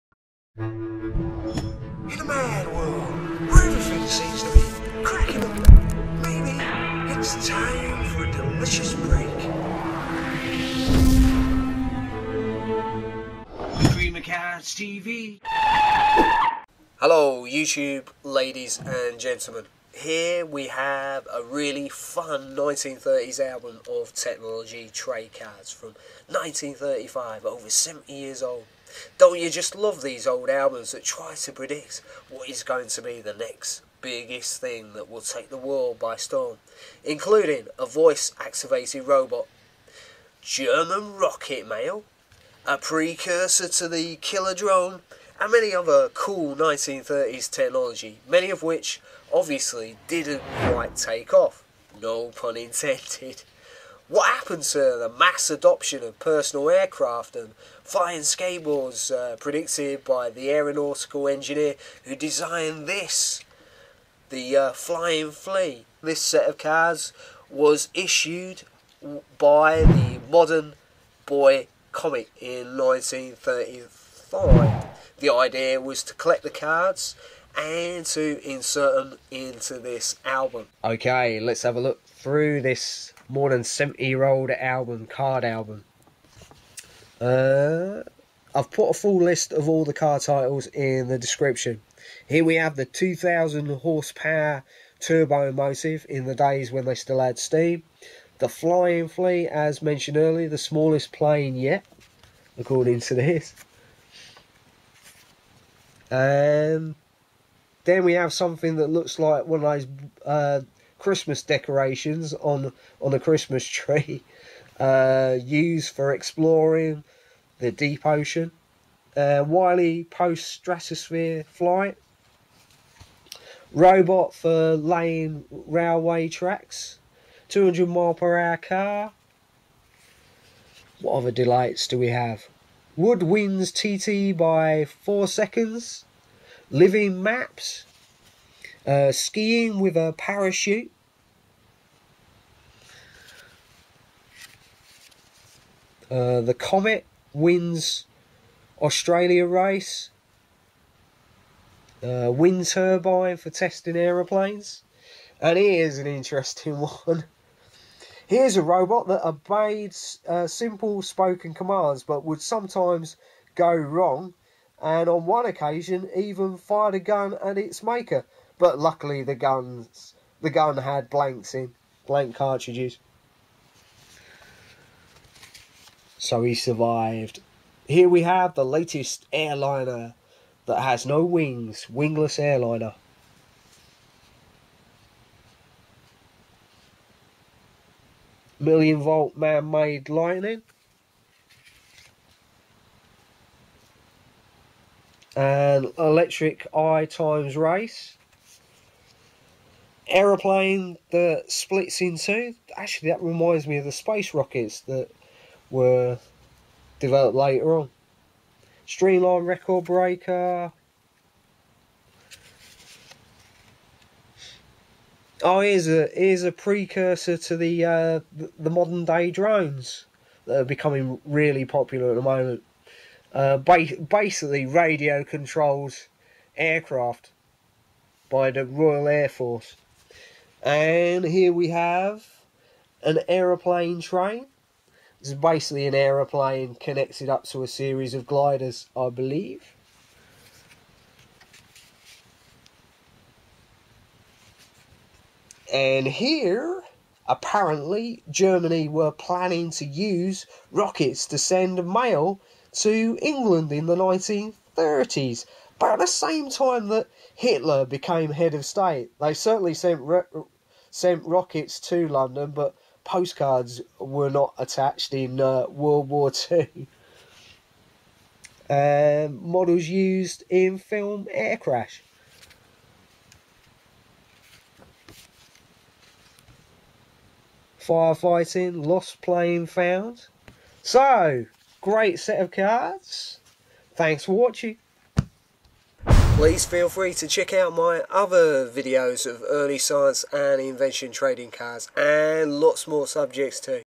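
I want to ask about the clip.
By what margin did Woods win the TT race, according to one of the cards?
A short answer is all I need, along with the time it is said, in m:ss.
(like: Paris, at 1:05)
four seconds, at 2:14.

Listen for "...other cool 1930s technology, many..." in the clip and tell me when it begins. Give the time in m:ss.
0:45.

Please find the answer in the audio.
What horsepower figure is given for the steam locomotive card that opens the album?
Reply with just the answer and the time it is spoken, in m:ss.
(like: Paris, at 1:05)
2000, at 1:32.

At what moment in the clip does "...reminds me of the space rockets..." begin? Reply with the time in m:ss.
3:23.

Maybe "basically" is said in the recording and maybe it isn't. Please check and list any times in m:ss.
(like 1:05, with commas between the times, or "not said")
3:44, 3:55.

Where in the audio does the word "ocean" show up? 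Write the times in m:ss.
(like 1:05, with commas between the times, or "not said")
1:58.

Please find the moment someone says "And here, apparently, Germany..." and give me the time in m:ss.
4:05.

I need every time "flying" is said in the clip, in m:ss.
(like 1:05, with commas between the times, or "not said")
0:57, 1:04, 1:38.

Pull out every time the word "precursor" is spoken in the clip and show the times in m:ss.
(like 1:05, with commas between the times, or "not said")
0:42, 3:36.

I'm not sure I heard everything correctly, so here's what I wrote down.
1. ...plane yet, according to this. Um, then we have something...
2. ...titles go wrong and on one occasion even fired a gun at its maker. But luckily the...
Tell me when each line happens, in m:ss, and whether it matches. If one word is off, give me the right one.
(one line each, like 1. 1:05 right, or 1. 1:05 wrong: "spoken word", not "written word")
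1. 1:41 right
2. 2:42 wrong: "sometimes", not "titles".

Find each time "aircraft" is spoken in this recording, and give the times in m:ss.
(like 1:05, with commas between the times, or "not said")
0:56, 3:46.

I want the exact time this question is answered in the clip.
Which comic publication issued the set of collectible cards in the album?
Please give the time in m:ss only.
1:10.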